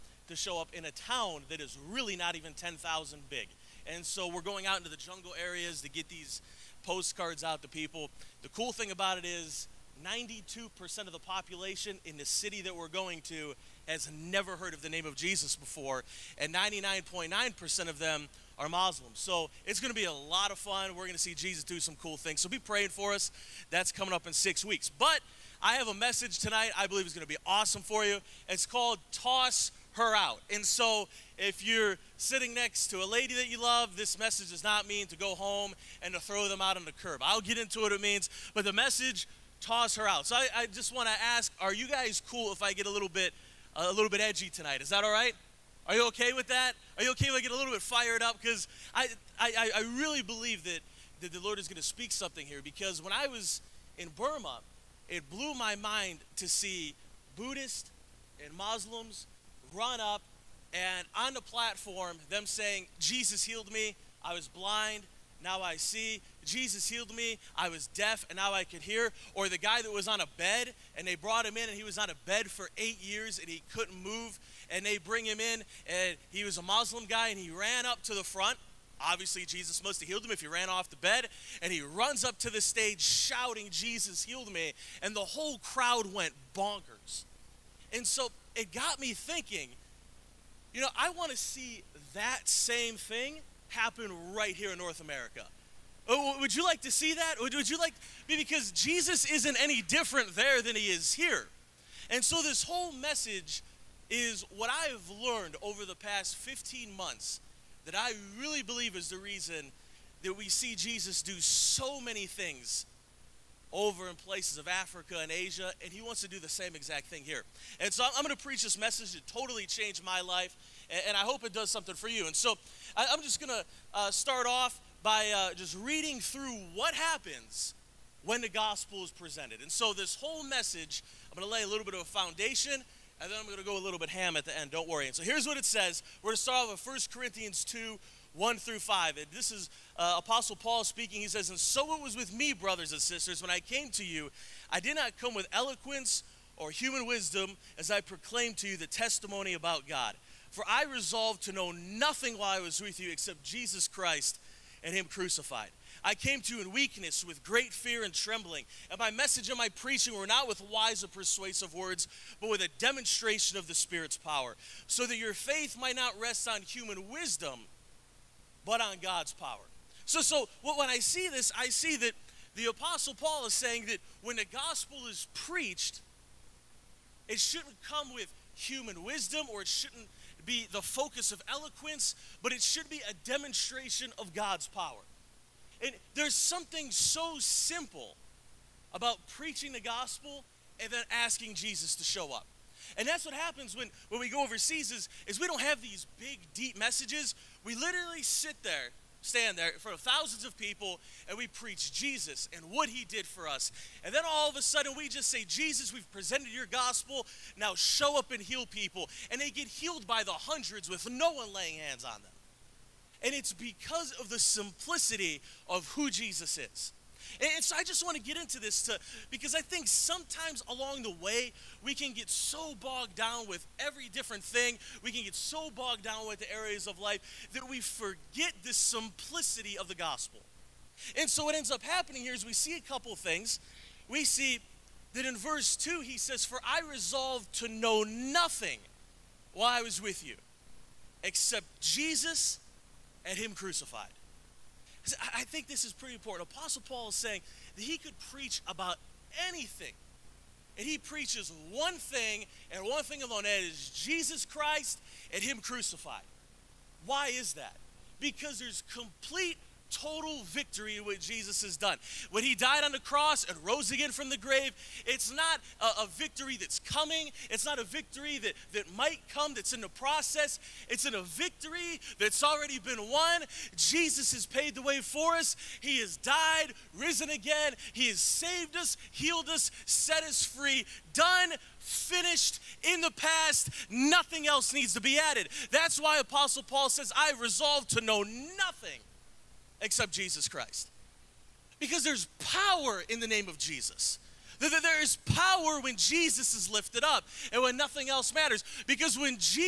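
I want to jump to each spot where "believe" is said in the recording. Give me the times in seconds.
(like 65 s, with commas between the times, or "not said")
26 s, 50 s, 108 s.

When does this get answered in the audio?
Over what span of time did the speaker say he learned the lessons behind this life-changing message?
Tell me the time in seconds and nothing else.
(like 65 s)
106 s.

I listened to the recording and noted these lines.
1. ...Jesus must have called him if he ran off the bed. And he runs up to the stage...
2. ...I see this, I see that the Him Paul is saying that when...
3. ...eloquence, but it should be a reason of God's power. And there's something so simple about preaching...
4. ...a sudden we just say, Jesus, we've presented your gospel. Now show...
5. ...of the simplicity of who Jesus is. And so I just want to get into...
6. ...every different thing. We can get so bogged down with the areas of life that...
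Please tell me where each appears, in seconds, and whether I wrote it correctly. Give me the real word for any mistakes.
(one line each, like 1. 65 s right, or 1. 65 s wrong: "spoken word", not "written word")
1. 79 s wrong: "healed", not "called"
2. 170 s wrong: "Apostle", not "Him"
3. 181 s wrong: "demonstration", not "reason"
4. 204 s right
5. 214 s right
6. 223 s right.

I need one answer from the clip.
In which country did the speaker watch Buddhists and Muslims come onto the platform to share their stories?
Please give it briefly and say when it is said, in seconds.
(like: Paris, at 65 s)
Burma, at 54 s.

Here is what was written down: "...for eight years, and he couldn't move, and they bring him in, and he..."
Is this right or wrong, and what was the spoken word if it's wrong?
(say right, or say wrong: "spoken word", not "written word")
right.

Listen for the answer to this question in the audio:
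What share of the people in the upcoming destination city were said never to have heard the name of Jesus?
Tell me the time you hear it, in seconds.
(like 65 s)
10 s.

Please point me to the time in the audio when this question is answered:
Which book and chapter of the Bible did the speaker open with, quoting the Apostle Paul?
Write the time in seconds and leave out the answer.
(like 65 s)
136 s.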